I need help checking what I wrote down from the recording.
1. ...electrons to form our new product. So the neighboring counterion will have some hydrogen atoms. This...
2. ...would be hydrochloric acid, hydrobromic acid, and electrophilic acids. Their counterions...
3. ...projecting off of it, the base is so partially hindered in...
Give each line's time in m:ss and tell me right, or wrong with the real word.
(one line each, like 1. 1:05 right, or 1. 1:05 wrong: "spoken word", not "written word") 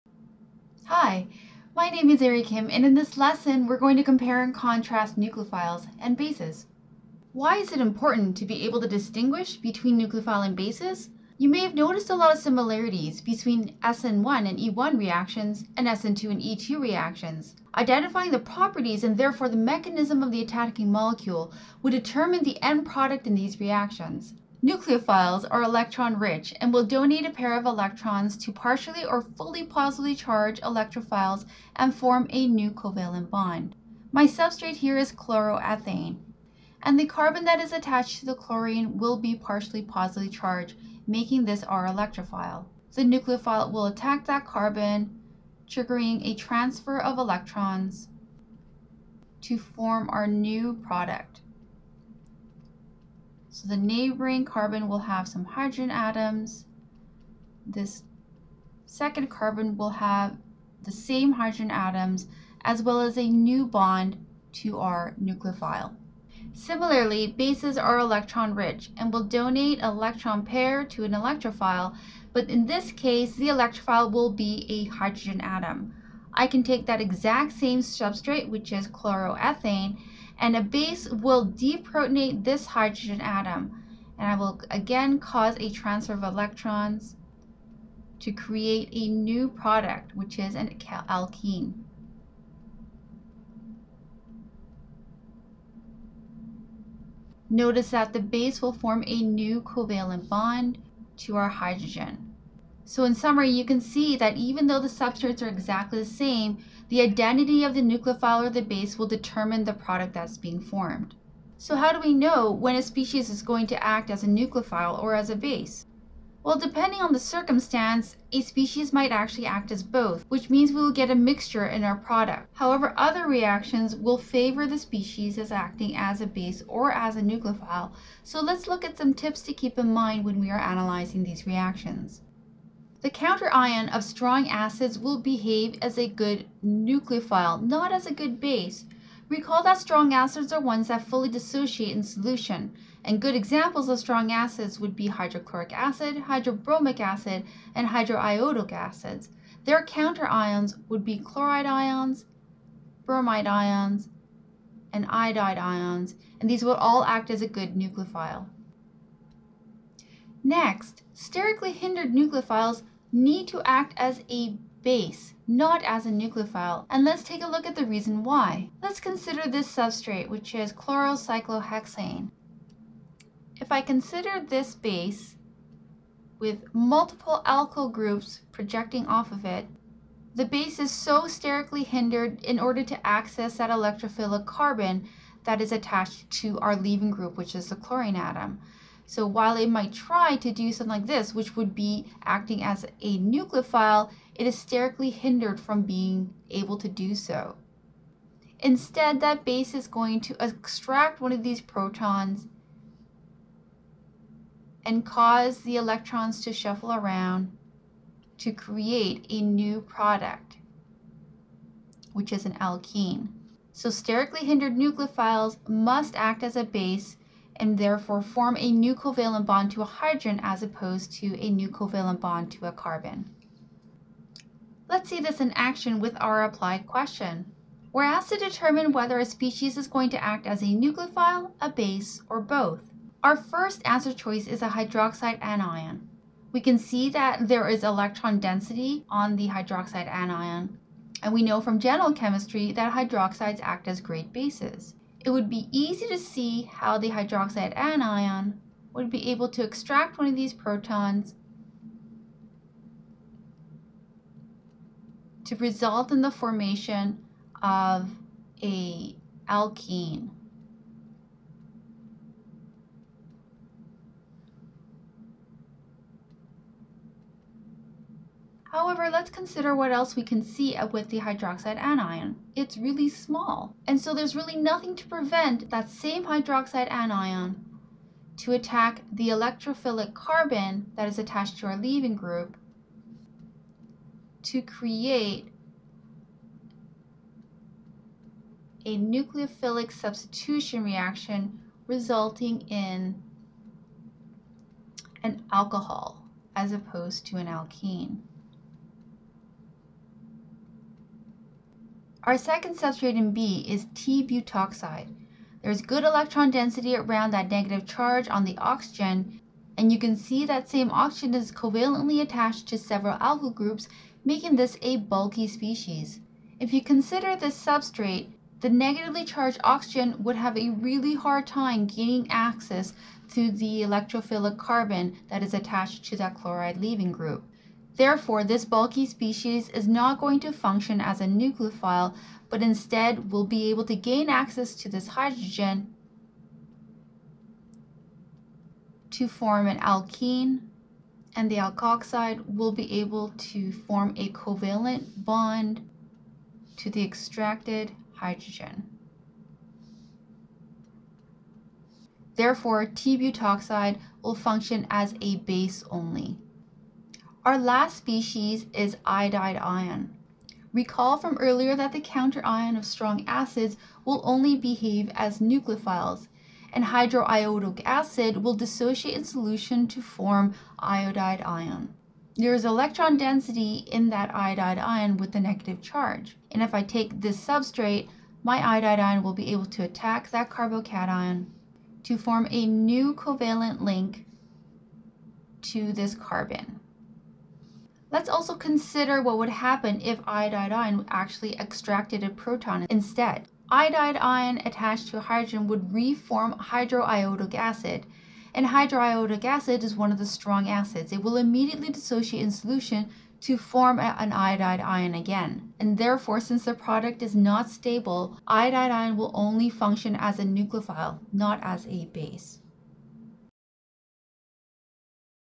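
1. 0:47 wrong: "carbon", not "counterion"
2. 2:24 wrong: "hydroiodic", not "electrophilic"
3. 2:58 wrong: "sterically", not "partially".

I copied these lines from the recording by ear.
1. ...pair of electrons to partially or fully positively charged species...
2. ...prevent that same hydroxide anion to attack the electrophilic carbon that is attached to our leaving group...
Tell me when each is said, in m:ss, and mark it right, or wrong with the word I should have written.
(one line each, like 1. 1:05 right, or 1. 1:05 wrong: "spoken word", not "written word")
1. 0:27 wrong: "electrophiles", not "species"
2. 4:35 right.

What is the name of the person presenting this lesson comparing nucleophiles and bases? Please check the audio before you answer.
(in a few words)
Eri Kim.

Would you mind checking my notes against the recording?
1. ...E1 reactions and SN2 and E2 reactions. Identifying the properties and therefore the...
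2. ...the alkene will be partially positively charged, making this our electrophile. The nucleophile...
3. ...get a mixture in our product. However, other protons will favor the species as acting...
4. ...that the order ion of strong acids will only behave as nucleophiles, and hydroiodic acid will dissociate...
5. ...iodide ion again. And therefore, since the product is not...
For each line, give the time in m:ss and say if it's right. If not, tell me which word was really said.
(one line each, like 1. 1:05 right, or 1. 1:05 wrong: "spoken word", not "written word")
1. 0:14 right
2. 0:38 wrong: "chlorine", not "alkene"
3. 2:00 wrong: "reactions", not "protons"
4. 6:01 wrong: "counter", not "order"
5. 6:44 right.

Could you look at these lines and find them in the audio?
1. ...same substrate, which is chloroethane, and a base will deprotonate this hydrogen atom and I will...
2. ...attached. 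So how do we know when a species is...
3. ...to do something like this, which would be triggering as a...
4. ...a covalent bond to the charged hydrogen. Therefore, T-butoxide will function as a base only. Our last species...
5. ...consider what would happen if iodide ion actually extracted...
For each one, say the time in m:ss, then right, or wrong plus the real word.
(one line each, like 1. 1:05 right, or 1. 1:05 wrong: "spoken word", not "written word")
1. 1:17 right
2. 1:50 wrong: "formed", not "attached"
3. 3:10 wrong: "acting", not "triggering"
4. 5:44 wrong: "extracted", not "charged"
5. 6:28 right.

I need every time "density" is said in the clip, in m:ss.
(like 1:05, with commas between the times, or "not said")
3:58, 5:06, 6:13.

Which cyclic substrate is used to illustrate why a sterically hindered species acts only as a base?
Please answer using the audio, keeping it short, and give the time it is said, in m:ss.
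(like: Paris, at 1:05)
chlorocyclohexane, at 2:50.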